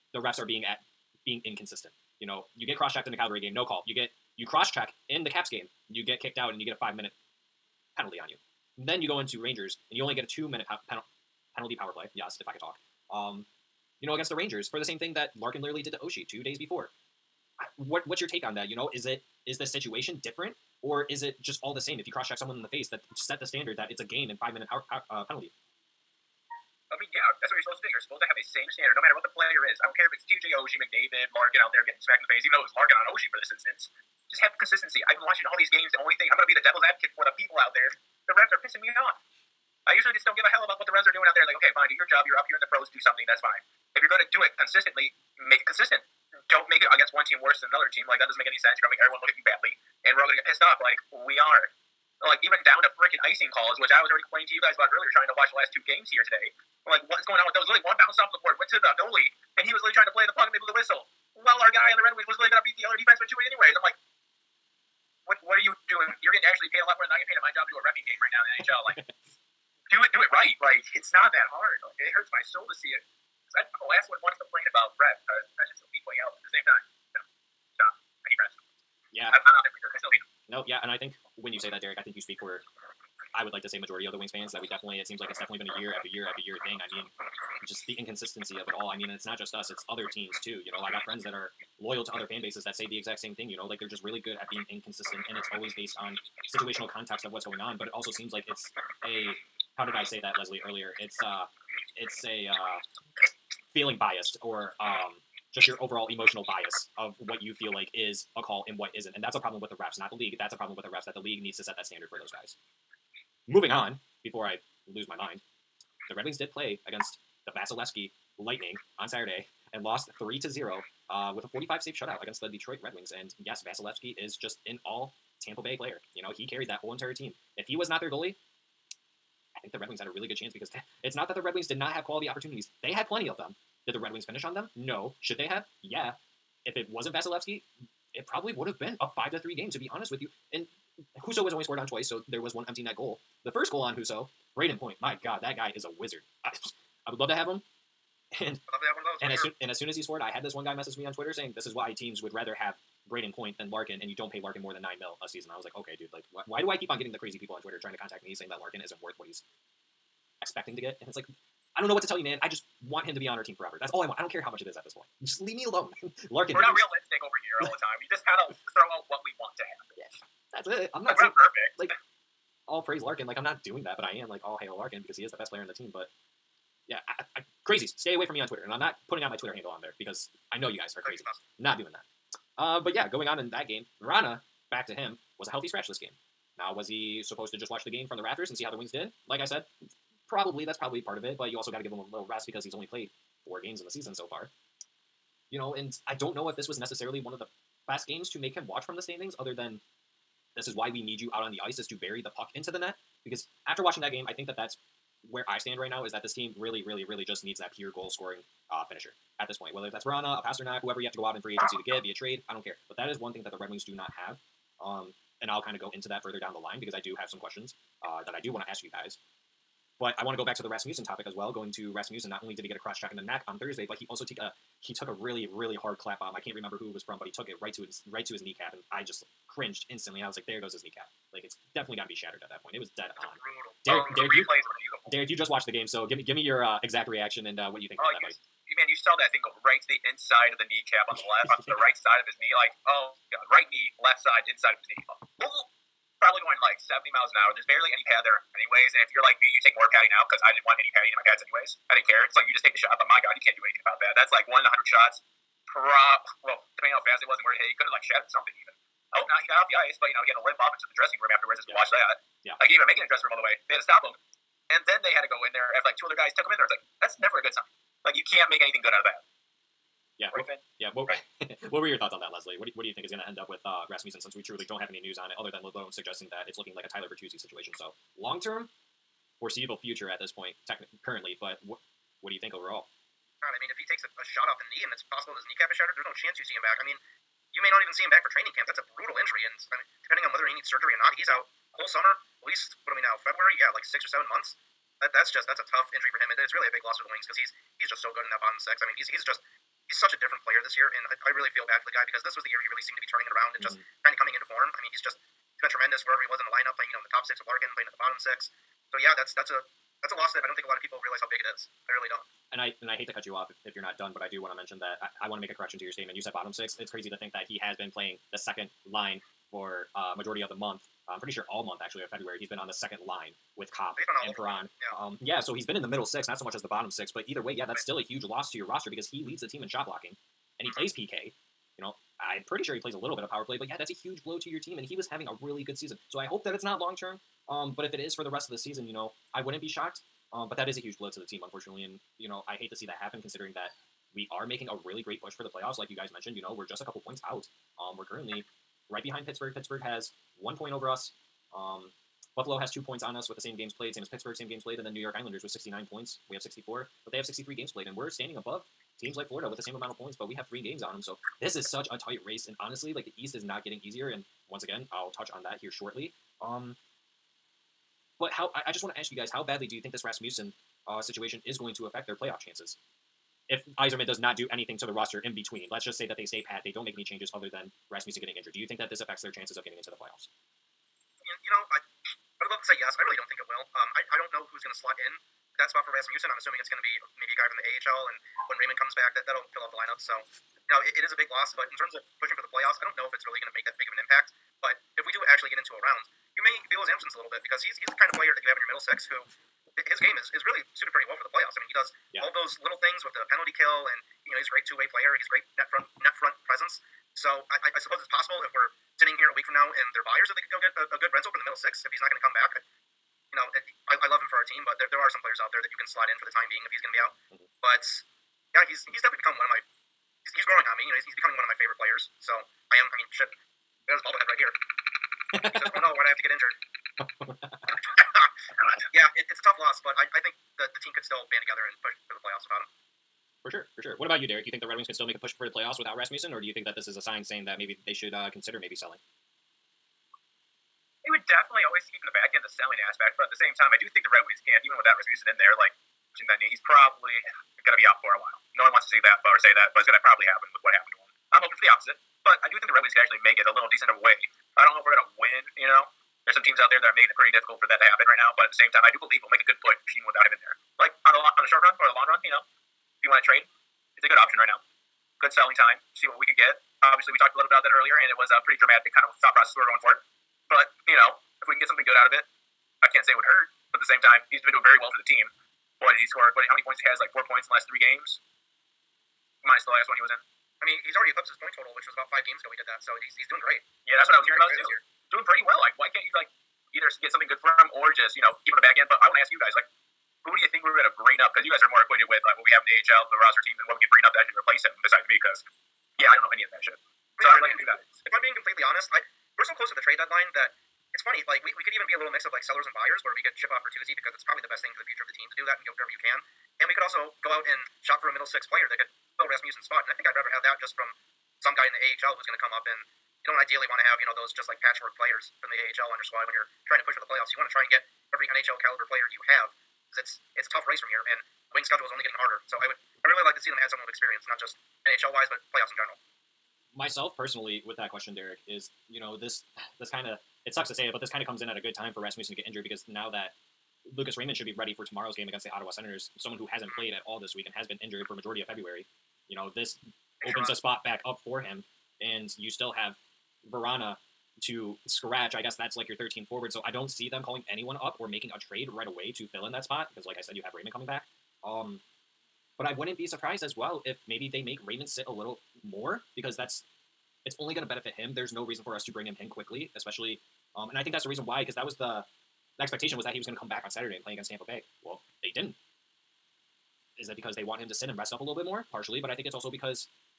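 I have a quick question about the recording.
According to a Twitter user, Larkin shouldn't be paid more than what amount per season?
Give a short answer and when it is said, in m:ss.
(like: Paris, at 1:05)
9 million, at 2:34.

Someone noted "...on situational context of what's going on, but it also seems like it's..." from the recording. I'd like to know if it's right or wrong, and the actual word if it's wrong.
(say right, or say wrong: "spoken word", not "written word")
right.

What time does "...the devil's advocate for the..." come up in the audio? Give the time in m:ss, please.
0:36.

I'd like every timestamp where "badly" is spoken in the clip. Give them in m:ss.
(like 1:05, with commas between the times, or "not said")
0:49, 6:09.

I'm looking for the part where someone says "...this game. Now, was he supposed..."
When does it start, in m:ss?
3:05.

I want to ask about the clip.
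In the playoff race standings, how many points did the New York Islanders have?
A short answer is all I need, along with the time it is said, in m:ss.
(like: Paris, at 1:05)
69, at 5:55.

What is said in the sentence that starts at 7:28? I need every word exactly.
No one wants to see that or say that, but it's going to probably happen with what happened to him.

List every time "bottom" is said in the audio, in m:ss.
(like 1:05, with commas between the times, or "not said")
4:58, 5:07, 5:16, 5:26.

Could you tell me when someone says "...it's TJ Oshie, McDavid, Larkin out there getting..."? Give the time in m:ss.
0:30.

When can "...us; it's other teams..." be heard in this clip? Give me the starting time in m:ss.
1:29.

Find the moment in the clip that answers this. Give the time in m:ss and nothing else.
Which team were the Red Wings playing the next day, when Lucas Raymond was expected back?
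8:55.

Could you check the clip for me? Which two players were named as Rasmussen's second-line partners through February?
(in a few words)
Copp and Perron.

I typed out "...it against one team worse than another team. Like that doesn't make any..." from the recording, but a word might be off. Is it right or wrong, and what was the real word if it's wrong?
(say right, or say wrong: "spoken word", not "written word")
right.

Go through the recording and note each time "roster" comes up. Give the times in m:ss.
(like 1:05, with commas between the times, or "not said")
5:28, 6:14, 8:13.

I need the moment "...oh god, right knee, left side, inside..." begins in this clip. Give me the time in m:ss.
4:02.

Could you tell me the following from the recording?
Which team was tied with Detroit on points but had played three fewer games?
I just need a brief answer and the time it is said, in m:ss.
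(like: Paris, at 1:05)
Florida, at 5:59.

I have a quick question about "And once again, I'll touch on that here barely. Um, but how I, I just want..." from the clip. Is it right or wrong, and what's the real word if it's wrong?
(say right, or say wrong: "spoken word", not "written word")
wrong: "shortly", not "barely".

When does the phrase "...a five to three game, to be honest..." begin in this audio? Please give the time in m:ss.
2:18.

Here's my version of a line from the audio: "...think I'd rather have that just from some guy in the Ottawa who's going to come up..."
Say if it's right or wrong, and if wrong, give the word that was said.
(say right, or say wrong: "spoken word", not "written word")
wrong: "AHL", not "Ottawa".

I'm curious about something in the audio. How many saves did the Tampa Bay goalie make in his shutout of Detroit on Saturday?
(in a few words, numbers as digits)
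45.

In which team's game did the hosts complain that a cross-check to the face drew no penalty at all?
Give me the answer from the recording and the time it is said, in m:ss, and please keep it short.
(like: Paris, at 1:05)
Calgary, at 0:03.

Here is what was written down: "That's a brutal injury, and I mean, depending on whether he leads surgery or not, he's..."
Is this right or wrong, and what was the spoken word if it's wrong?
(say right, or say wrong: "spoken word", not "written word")
wrong: "needs", not "leads".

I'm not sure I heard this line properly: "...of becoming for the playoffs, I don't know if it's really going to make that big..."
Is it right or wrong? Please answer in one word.
wrong.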